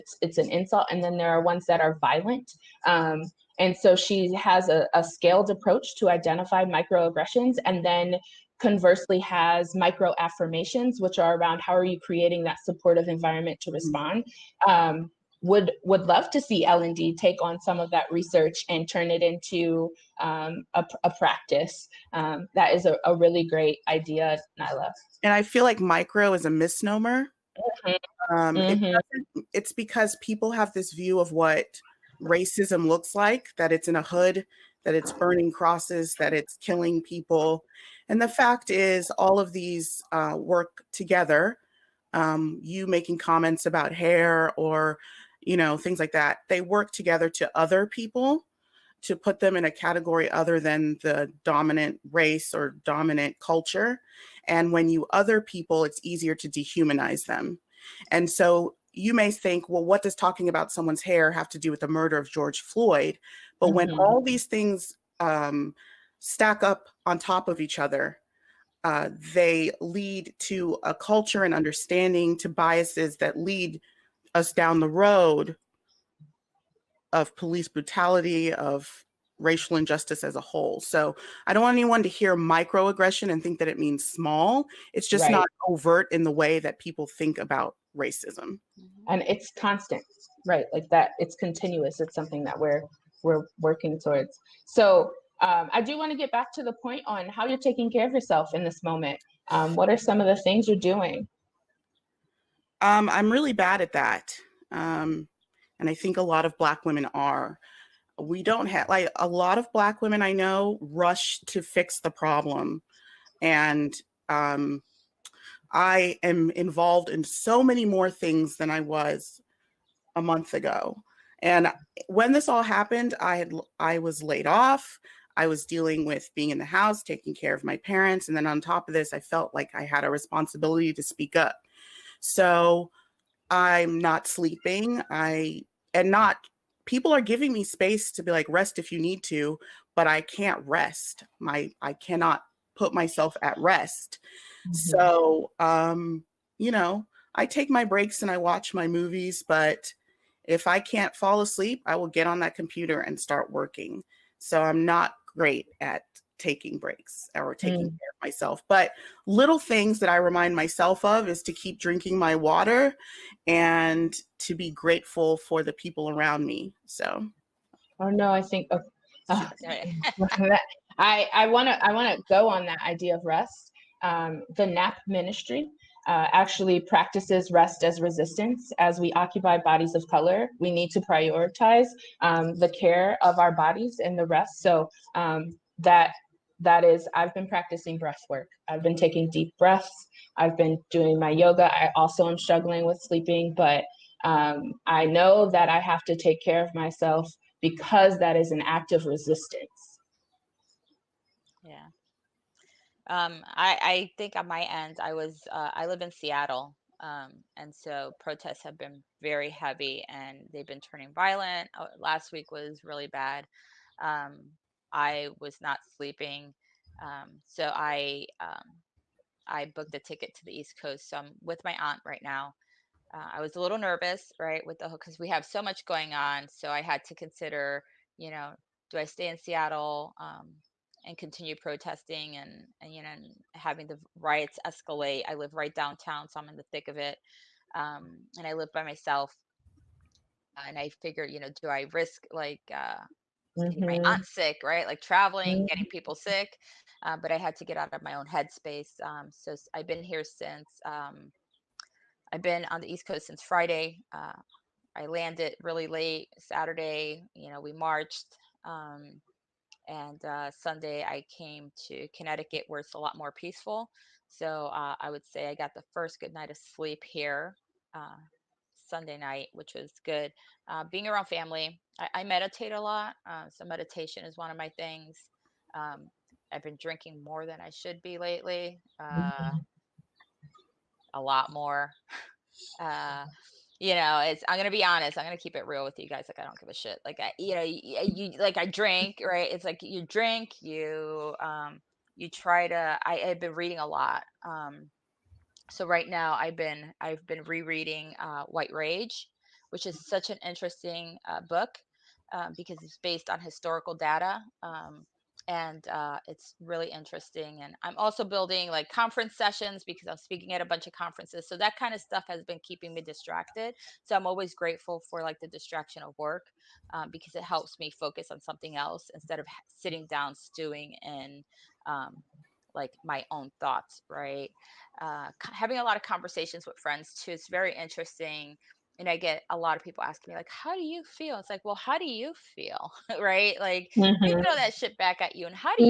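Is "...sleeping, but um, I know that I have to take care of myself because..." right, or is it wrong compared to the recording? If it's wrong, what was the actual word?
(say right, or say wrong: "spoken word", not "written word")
right.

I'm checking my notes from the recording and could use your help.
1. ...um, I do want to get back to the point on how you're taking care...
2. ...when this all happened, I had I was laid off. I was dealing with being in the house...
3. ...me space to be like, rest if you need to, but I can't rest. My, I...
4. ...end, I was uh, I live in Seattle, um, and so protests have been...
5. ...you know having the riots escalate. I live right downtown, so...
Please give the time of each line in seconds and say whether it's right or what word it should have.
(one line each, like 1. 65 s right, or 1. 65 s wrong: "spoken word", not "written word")
1. 95 s right
2. 122 s right
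3. 137 s right
4. 204 s right
5. 232 s right.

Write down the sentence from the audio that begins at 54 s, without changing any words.
And when you other people, it's easier to dehumanize them.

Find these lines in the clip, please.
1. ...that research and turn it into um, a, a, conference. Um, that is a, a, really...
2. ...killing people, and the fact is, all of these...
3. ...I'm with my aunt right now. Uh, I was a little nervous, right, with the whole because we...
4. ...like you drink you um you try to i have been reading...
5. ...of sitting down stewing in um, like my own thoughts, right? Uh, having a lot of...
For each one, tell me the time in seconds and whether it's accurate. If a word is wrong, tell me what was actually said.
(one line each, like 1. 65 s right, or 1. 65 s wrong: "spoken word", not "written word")
1. 17 s wrong: "practice", not "conference"
2. 36 s right
3. 221 s right
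4. 289 s right
5. 319 s right.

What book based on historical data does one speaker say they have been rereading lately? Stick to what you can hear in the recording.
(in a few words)
White Rage.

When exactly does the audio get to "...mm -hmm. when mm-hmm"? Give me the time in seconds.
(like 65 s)
63 s.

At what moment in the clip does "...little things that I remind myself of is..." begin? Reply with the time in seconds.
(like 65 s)
159 s.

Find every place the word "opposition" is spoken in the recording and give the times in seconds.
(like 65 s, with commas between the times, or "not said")
not said.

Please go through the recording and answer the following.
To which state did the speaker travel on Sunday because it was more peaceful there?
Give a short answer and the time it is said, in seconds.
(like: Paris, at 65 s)
Connecticut, at 262 s.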